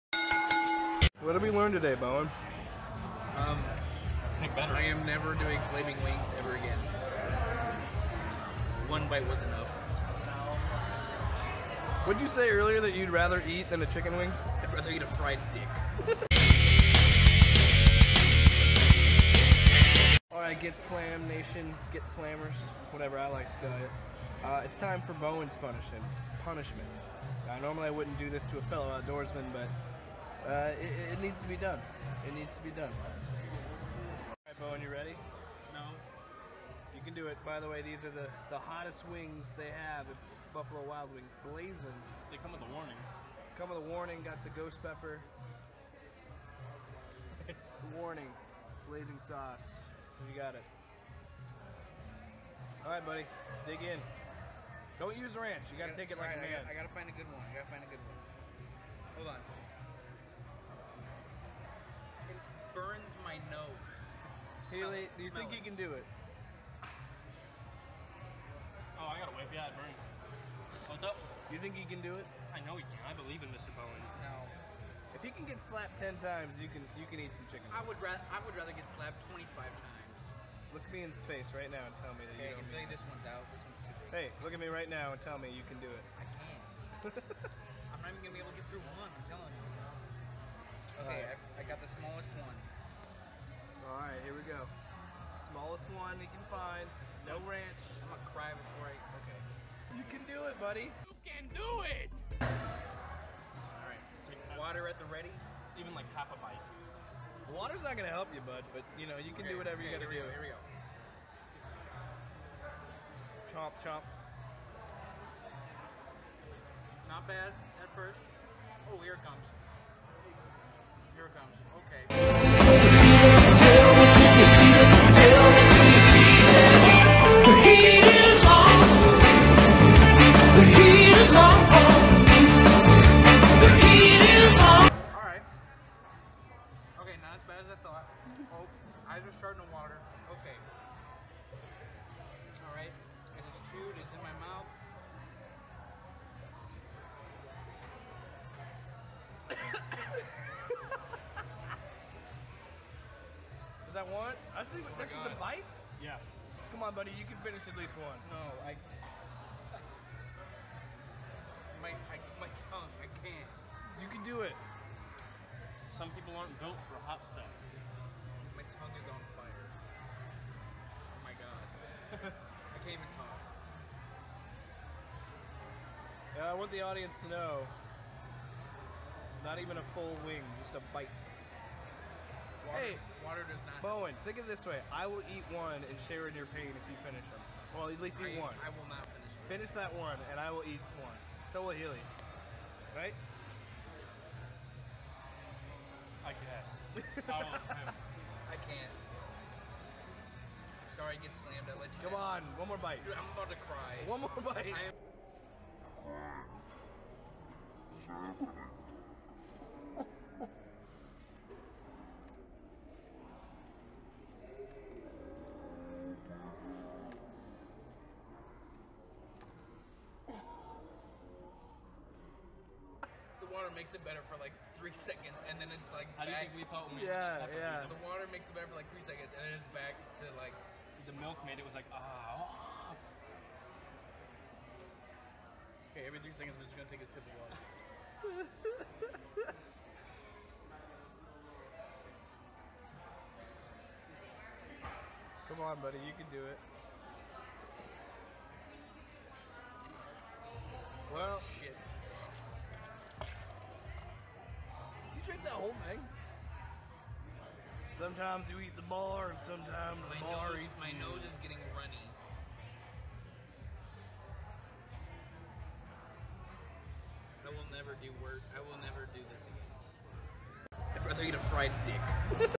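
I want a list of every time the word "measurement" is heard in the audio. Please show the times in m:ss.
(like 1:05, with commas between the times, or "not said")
not said.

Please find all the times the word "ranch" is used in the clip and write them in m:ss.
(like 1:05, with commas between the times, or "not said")
0:55, 1:37.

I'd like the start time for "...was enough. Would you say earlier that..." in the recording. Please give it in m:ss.
0:09.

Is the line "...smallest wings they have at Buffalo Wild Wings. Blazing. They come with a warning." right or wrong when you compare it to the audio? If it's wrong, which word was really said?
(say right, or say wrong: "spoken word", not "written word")
wrong: "hottest", not "smallest".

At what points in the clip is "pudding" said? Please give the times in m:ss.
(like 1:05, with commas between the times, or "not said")
not said.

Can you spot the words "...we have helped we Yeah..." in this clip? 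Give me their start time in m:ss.
3:46.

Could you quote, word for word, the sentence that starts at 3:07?
Well, at least eat I, one.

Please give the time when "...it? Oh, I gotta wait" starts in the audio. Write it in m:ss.
1:05.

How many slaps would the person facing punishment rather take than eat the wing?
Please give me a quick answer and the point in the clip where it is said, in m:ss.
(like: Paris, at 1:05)
25, at 1:19.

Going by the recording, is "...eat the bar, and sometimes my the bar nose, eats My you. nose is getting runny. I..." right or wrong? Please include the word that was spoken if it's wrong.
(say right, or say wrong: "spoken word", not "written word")
right.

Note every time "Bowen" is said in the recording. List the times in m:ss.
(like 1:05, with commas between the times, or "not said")
0:01, 0:25, 0:34, 1:13, 3:03.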